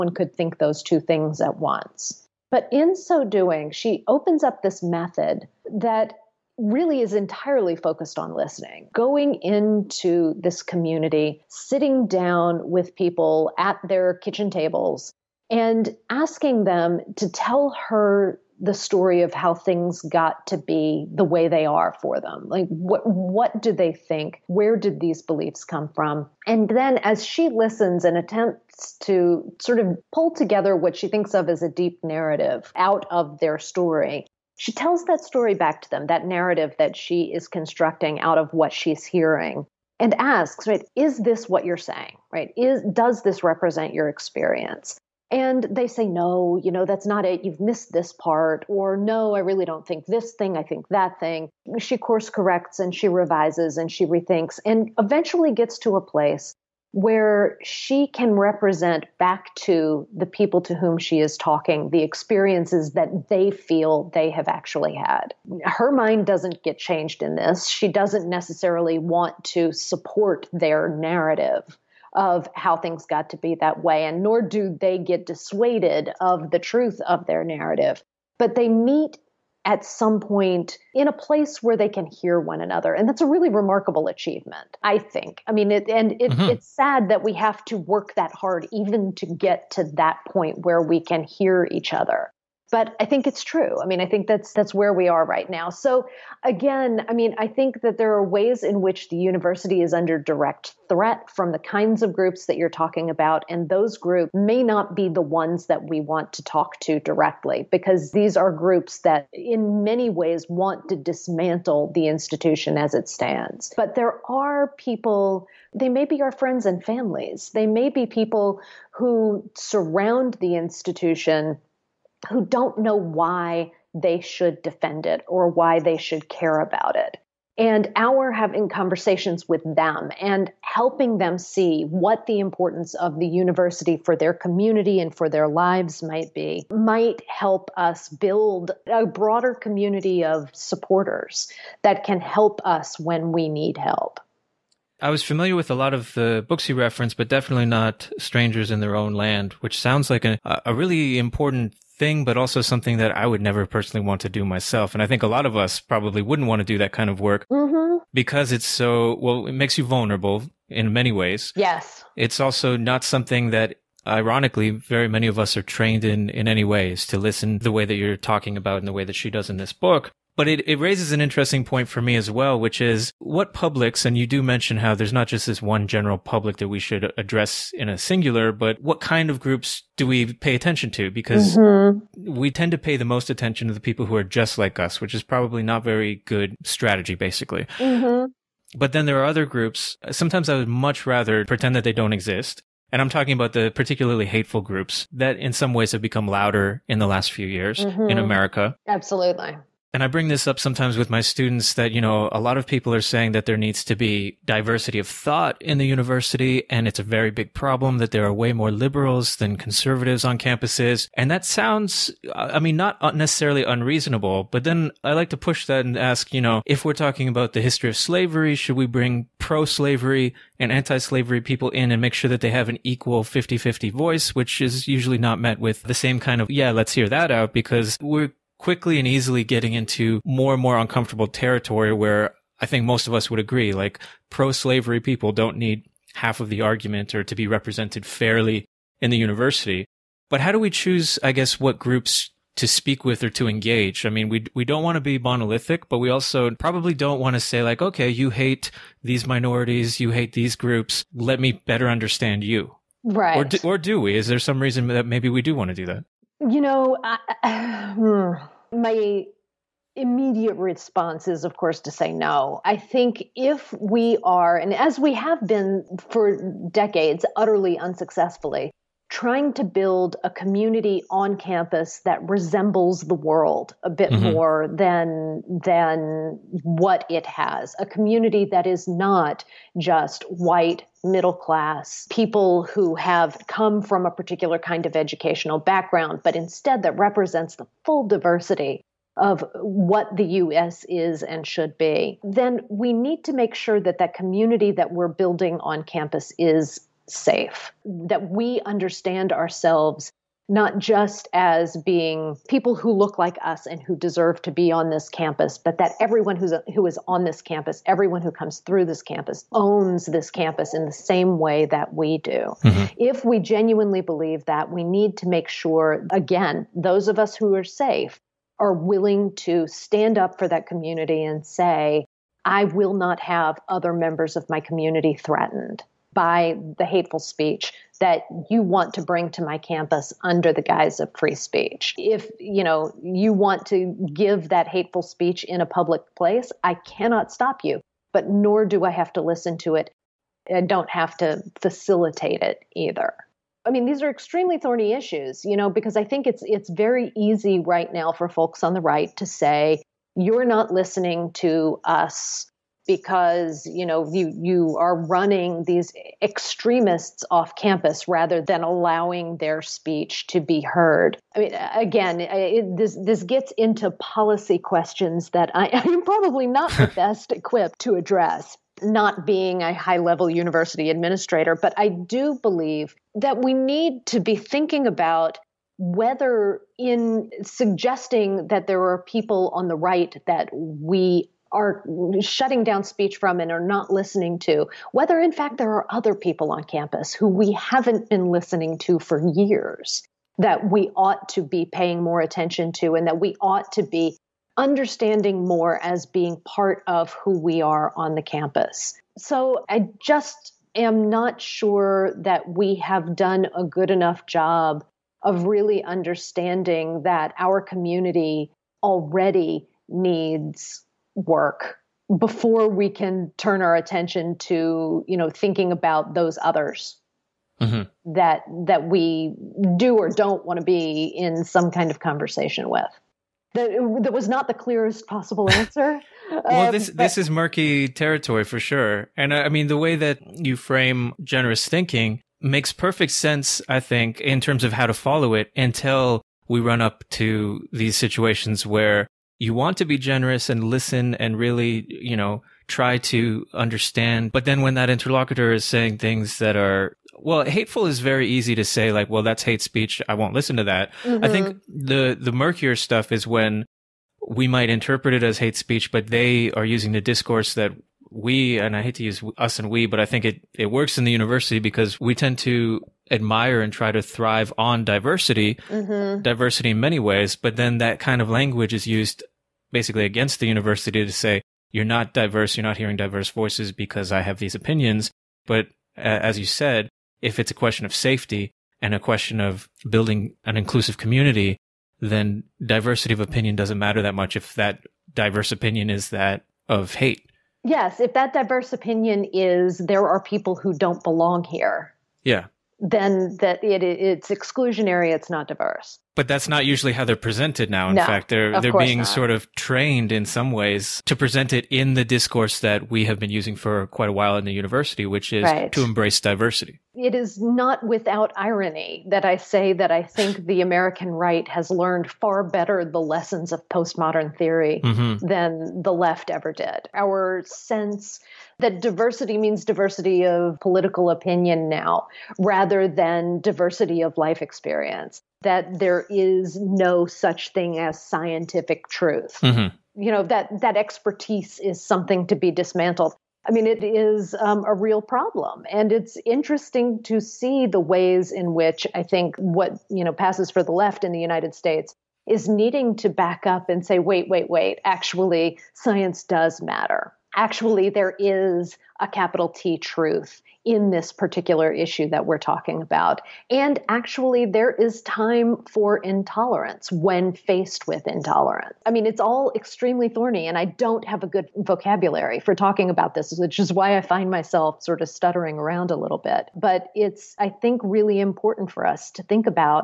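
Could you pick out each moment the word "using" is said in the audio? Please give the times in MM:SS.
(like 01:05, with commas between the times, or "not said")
07:36, 08:23.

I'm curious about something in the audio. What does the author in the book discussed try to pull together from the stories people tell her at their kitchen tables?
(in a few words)
A deep narrative.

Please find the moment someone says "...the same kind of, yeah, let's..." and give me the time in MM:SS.
03:45.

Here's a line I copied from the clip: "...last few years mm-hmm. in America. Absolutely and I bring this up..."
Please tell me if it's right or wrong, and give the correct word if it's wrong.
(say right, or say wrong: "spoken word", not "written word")
right.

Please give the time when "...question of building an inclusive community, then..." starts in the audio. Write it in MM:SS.
07:58.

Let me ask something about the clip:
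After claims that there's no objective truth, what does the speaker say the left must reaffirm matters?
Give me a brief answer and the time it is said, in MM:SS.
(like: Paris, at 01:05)
Science, at 09:05.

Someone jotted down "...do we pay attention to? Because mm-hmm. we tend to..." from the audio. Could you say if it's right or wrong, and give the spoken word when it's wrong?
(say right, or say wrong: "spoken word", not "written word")
right.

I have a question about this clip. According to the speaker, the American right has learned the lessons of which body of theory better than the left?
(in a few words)
Postmodern theory.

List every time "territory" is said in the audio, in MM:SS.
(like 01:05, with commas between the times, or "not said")
03:51, 07:07.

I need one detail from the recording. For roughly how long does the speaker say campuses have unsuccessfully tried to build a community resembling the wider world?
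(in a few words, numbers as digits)
Decades.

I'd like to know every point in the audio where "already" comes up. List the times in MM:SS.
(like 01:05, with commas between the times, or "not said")
06:48.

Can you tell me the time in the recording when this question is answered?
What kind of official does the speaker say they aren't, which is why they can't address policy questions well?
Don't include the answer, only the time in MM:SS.
06:09.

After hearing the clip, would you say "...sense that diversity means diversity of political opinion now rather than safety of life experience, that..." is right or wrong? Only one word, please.
wrong.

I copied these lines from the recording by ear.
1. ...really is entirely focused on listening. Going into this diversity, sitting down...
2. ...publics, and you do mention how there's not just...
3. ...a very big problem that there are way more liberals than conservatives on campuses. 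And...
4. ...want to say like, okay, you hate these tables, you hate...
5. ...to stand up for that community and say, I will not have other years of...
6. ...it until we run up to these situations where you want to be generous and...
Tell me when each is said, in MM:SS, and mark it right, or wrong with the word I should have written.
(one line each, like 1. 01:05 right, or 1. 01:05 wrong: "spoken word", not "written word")
1. 00:06 wrong: "community", not "diversity"
2. 02:53 right
3. 03:26 right
4. 04:07 wrong: "minorities", not "tables"
5. 05:19 wrong: "members", not "years"
6. 07:15 right.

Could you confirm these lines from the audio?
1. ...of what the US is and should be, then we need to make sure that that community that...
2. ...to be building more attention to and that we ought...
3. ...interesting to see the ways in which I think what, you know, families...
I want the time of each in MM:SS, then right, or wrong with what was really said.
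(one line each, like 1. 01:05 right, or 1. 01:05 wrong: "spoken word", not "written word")
1. 04:49 right
2. 06:31 wrong: "paying", not "building"
3. 08:56 wrong: "passes", not "families".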